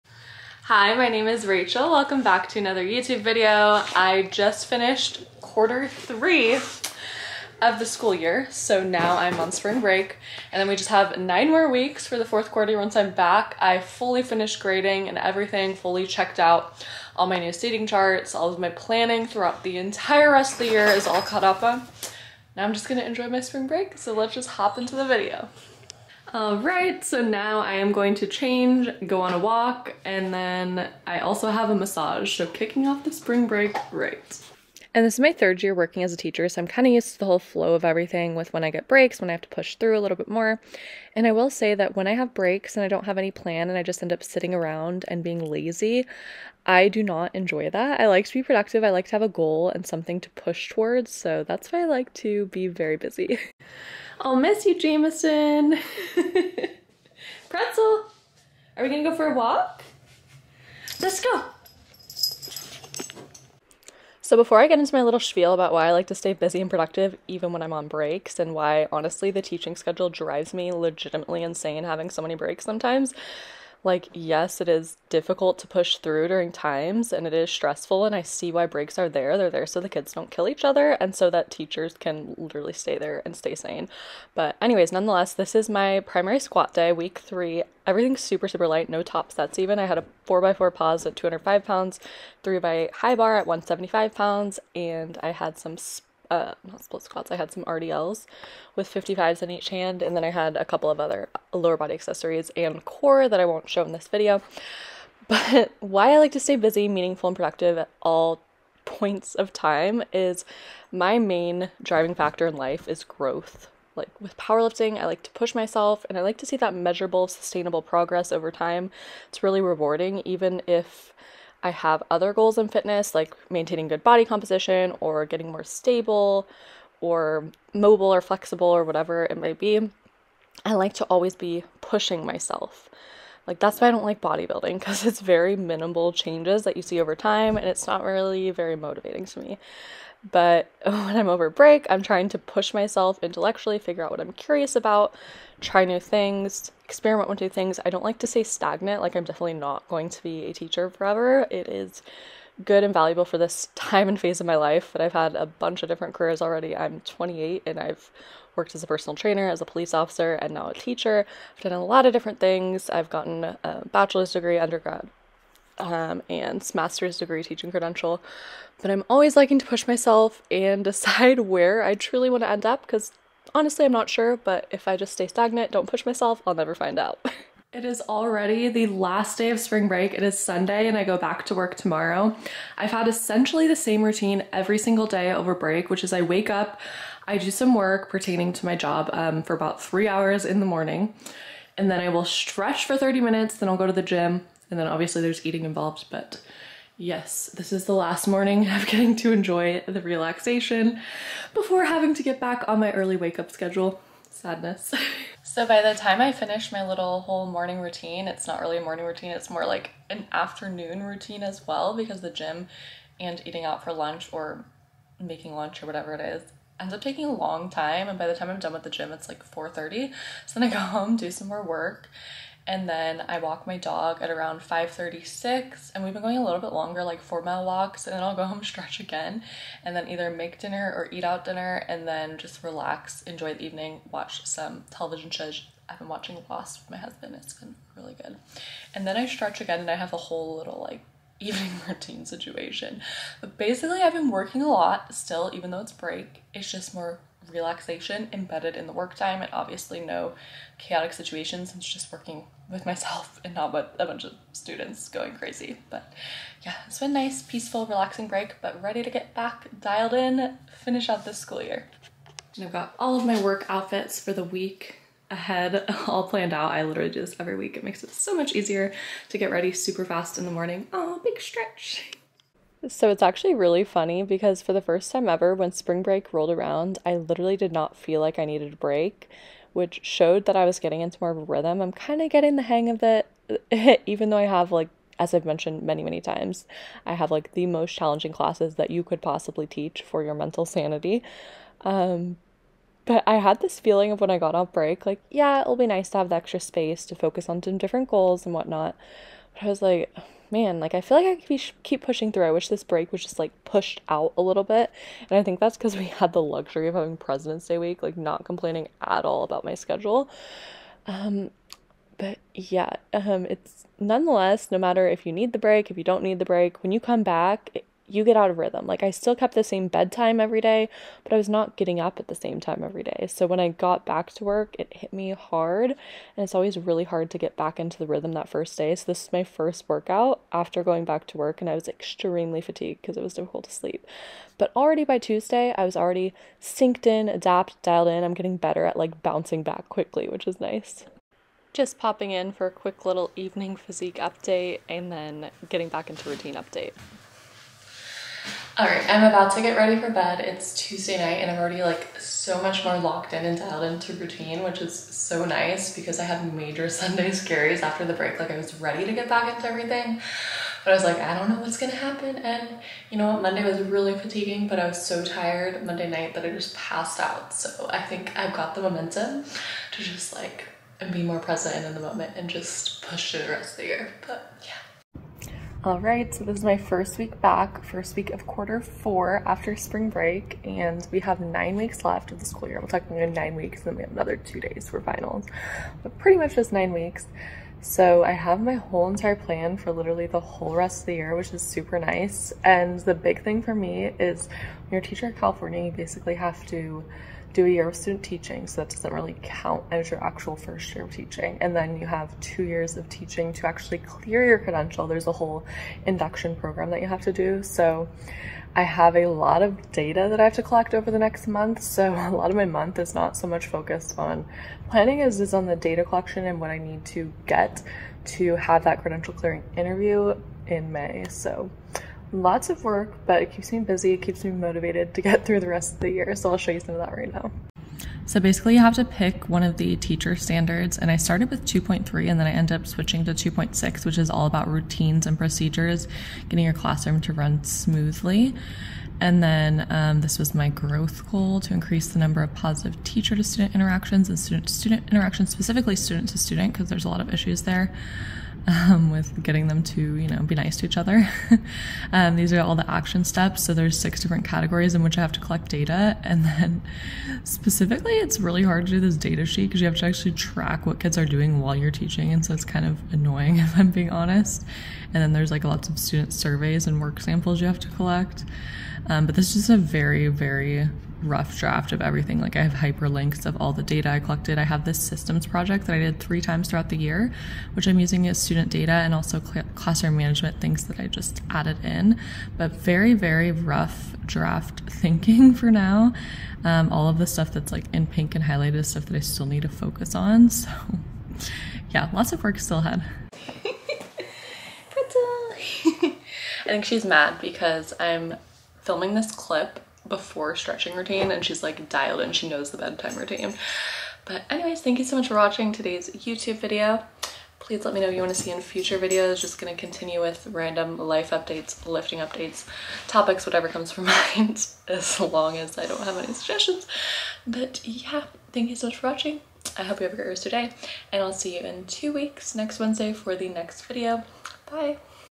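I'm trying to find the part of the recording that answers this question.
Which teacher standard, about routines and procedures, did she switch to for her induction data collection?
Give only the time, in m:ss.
7:13.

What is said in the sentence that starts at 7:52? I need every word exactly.
Like I have hyperlinks of all the data I collected.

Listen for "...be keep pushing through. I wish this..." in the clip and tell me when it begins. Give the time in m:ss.
5:01.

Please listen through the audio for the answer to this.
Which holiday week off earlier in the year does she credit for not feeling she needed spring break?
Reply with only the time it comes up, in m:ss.
5:07.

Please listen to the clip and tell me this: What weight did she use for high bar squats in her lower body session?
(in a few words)
175 pounds.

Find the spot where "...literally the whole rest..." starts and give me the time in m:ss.
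6:29.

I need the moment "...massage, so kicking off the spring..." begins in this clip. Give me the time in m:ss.
0:31.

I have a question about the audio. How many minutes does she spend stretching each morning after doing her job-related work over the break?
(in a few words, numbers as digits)
30.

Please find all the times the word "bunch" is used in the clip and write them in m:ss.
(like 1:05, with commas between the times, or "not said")
2:35, 4:14.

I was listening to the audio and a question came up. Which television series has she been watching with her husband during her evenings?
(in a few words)
Lost.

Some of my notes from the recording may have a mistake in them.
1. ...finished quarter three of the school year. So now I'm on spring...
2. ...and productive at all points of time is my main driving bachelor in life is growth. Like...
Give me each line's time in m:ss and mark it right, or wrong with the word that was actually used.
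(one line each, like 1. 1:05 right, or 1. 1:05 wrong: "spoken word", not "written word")
1. 0:04 right
2. 1:47 wrong: "factor", not "bachelor".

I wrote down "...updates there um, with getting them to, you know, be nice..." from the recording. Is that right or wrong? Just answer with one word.
wrong.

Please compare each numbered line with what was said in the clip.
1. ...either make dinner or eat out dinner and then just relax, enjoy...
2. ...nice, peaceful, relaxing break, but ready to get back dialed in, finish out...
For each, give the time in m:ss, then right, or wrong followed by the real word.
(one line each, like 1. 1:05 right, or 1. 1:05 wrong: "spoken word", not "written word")
1. 3:50 right
2. 4:17 right.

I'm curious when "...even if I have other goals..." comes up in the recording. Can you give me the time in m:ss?
2:00.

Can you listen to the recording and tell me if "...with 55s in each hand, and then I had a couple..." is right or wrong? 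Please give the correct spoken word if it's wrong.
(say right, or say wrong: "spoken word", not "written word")
right.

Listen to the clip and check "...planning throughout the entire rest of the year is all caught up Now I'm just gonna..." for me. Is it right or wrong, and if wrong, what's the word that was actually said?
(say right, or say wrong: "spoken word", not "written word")
right.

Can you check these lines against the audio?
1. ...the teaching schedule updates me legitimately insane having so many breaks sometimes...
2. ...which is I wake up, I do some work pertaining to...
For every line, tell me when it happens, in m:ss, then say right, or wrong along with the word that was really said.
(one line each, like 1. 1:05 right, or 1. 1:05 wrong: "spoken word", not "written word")
1. 1:09 wrong: "drives", not "updates"
2. 3:05 right.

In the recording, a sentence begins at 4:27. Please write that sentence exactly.
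It makes it so much easier to get ready super fast in the morning.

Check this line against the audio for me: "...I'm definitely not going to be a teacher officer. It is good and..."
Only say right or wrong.
wrong.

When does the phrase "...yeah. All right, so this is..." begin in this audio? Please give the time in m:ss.
6:14.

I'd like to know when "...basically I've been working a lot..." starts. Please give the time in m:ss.
4:03.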